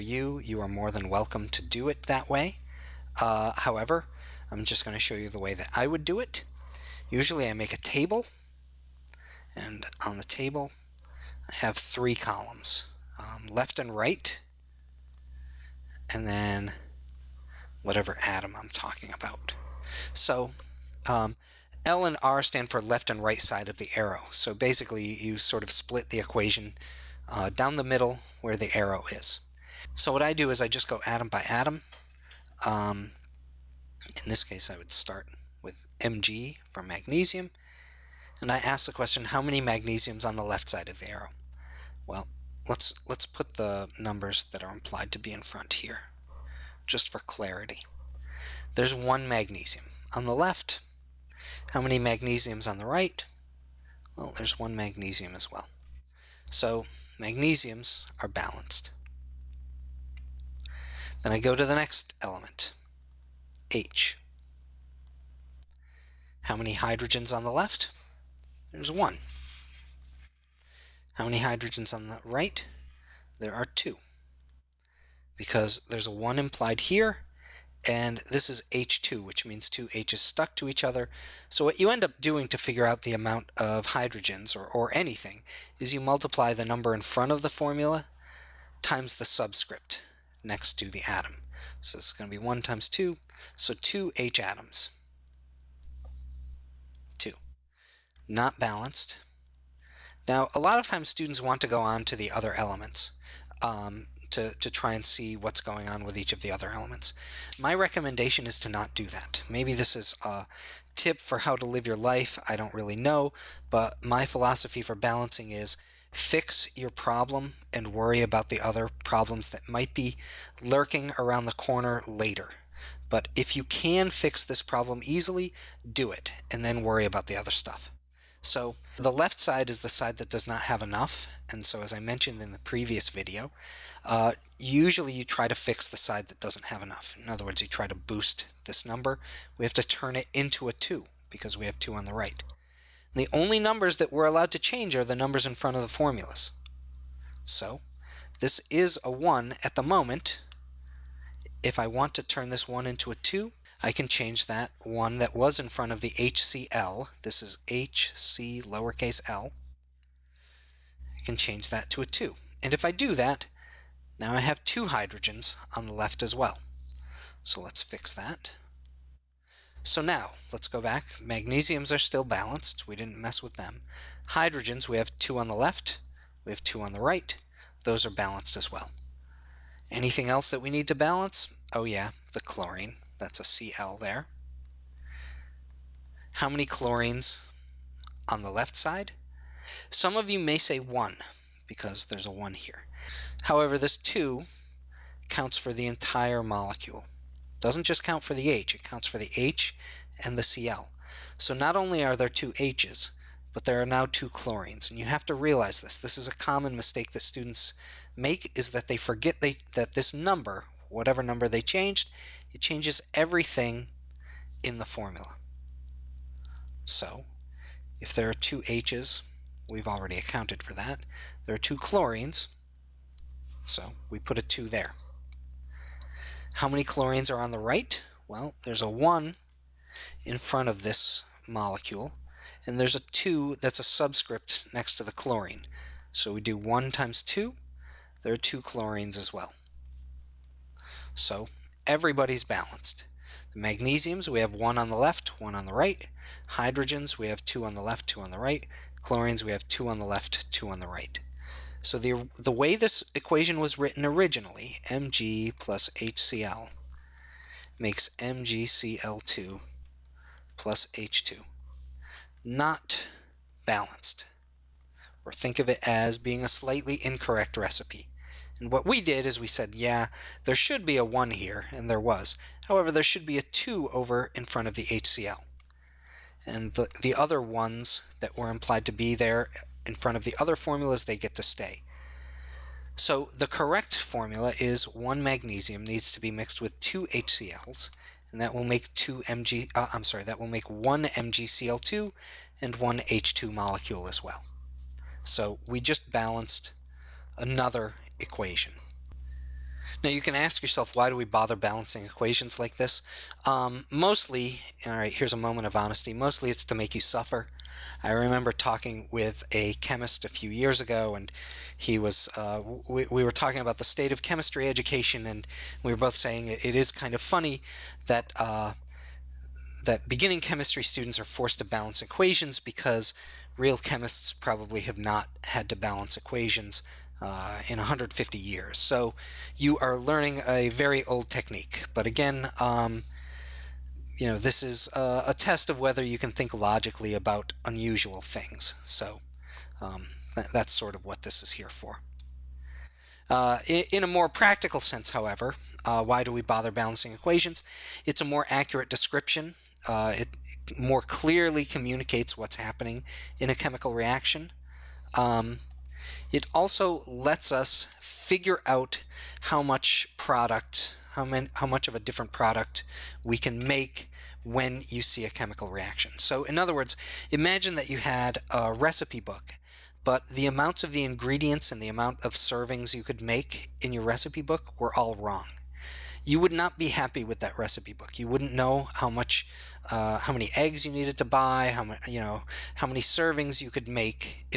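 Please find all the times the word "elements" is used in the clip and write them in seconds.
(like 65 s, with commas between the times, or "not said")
62 s, 102 s, 106 s.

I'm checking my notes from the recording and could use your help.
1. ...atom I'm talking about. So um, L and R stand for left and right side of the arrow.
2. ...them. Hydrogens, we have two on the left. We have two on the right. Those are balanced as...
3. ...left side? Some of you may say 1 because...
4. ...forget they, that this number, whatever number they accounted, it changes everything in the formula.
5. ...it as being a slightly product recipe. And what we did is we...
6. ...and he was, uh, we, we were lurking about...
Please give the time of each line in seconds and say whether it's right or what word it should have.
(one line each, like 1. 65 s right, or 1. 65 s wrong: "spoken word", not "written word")
1. 18 s right
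2. 173 s right
3. 188 s right
4. 208 s wrong: "changed", not "accounted"
5. 265 s wrong: "incorrect", not "product"
6. 311 s wrong: "talking", not "lurking".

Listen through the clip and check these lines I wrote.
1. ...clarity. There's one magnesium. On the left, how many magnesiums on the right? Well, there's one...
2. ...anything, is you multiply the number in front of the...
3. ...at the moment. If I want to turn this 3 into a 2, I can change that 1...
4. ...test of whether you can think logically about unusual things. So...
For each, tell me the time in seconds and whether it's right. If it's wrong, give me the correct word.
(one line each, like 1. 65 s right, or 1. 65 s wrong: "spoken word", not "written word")
1. 47 s right
2. 84 s right
3. 149 s wrong: "1", not "3"
4. 335 s right.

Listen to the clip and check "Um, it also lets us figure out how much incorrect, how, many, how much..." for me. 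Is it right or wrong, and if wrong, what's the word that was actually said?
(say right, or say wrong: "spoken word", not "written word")
wrong: "product", not "incorrect".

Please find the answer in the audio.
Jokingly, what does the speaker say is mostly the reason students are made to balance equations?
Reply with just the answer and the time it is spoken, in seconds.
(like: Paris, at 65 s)
To make you suffer, at 306 s.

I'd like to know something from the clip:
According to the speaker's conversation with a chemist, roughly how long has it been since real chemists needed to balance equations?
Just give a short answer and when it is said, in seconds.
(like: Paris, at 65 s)
150 years, at 327 s.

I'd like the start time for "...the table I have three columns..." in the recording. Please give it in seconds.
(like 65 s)
10 s.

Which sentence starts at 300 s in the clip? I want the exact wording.
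Now you can ask yourself, why do we bother balancing equations like this?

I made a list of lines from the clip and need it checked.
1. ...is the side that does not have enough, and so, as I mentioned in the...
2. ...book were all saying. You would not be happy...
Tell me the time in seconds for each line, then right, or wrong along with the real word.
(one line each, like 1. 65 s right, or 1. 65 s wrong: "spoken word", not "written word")
1. 129 s right
2. 374 s wrong: "wrong", not "saying".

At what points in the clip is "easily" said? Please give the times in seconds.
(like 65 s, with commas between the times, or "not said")
125 s.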